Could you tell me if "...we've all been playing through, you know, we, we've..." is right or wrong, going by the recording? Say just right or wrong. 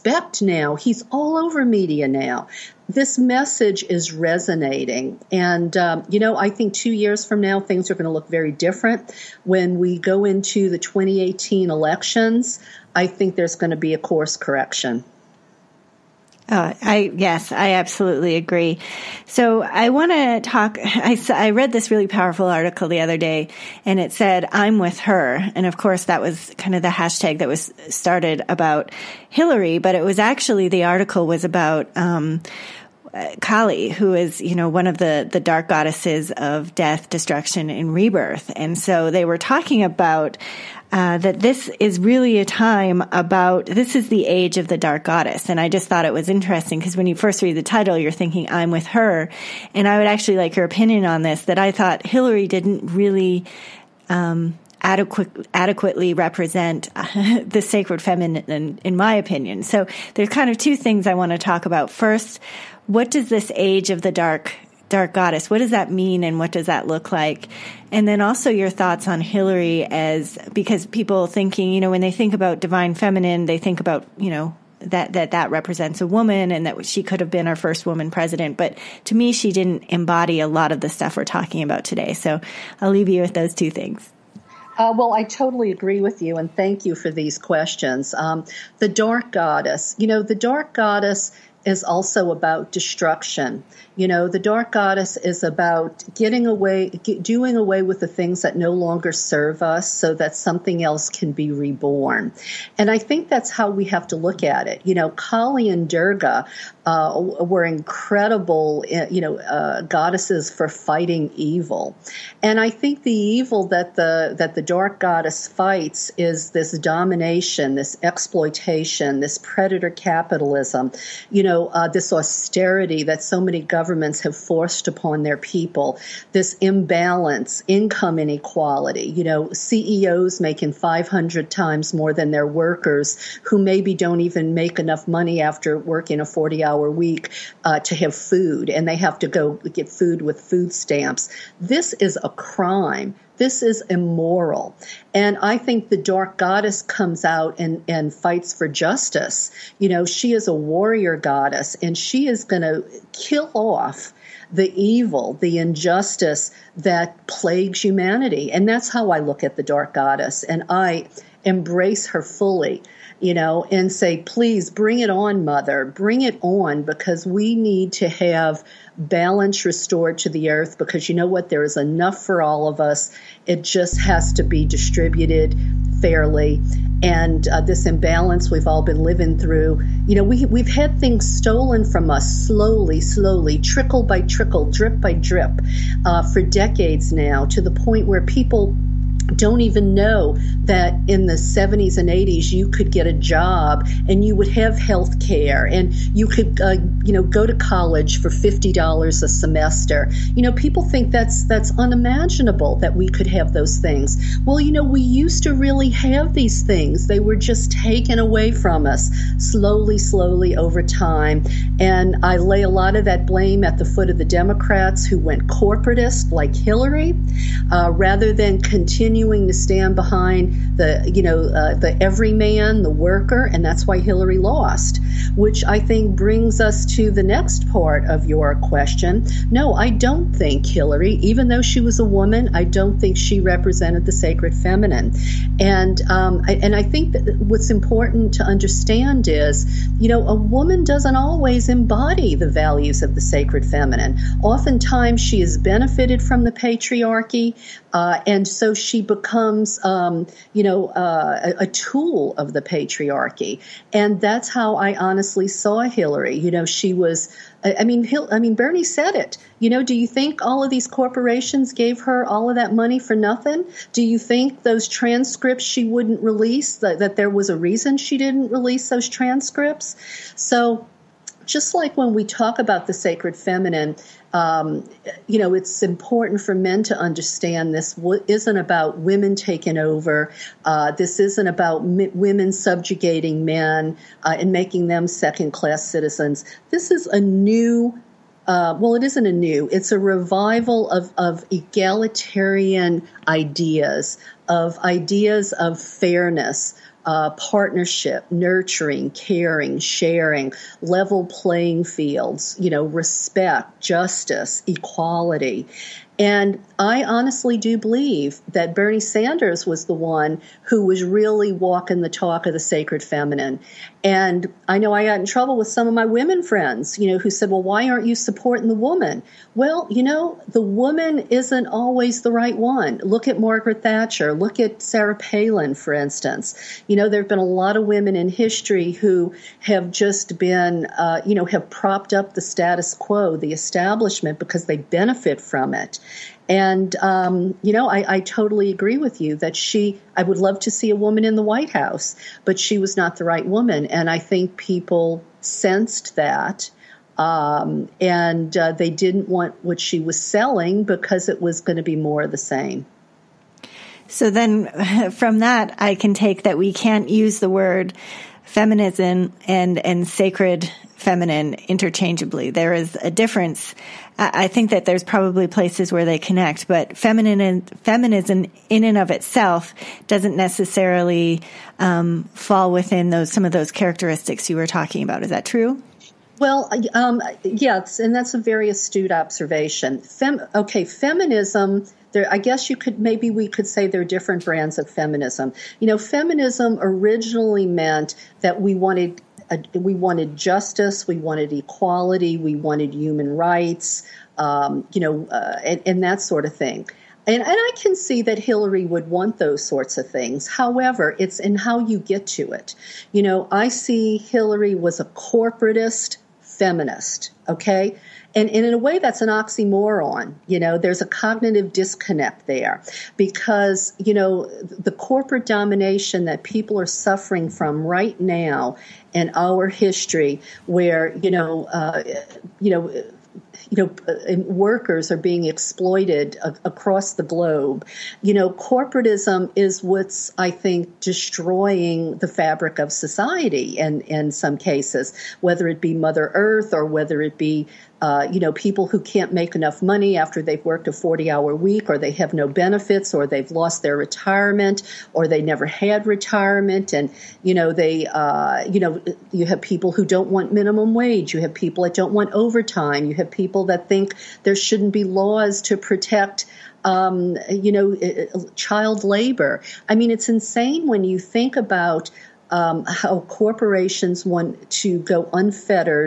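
wrong.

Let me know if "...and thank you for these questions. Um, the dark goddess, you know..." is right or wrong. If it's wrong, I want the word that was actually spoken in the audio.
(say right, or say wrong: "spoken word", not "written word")
right.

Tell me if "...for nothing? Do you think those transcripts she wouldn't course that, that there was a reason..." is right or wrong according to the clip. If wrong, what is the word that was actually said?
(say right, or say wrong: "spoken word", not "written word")
wrong: "release", not "course".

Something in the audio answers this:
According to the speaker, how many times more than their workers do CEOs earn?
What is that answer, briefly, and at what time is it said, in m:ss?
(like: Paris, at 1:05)
500 times, at 2:10.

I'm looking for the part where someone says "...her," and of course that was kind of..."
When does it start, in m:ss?
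0:25.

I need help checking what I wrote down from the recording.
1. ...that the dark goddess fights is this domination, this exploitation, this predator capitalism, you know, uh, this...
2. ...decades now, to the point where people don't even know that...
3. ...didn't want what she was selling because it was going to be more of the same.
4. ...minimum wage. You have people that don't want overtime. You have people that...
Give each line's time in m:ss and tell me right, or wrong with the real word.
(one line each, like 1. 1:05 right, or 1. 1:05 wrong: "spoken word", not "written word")
1. 1:54 right
2. 3:06 right
3. 5:48 right
4. 7:30 right.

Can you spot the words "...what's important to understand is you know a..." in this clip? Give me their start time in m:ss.
3:57.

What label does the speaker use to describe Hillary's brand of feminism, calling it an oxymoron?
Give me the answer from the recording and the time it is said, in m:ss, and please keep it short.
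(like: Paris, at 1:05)
corporatist feminist, at 6:45.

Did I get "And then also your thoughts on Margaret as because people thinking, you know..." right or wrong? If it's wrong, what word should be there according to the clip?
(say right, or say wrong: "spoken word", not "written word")
wrong: "Hillary", not "Margaret".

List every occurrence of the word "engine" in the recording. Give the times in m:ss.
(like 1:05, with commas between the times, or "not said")
not said.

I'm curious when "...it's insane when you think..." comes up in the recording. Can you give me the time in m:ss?
7:40.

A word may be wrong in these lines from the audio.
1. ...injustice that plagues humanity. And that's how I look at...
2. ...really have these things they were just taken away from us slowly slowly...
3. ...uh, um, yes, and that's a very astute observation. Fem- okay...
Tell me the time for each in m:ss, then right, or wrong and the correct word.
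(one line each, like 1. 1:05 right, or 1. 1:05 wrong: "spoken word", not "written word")
1. 2:35 right
2. 3:25 right
3. 6:16 right.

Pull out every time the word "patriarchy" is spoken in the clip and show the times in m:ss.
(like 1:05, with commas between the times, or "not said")
4:06, 4:12.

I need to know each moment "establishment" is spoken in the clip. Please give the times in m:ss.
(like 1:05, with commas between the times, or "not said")
5:33.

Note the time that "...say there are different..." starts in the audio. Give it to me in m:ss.
6:23.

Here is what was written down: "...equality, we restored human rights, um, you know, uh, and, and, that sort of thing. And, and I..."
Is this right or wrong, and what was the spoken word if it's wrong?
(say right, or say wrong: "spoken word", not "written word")
wrong: "wanted", not "restored".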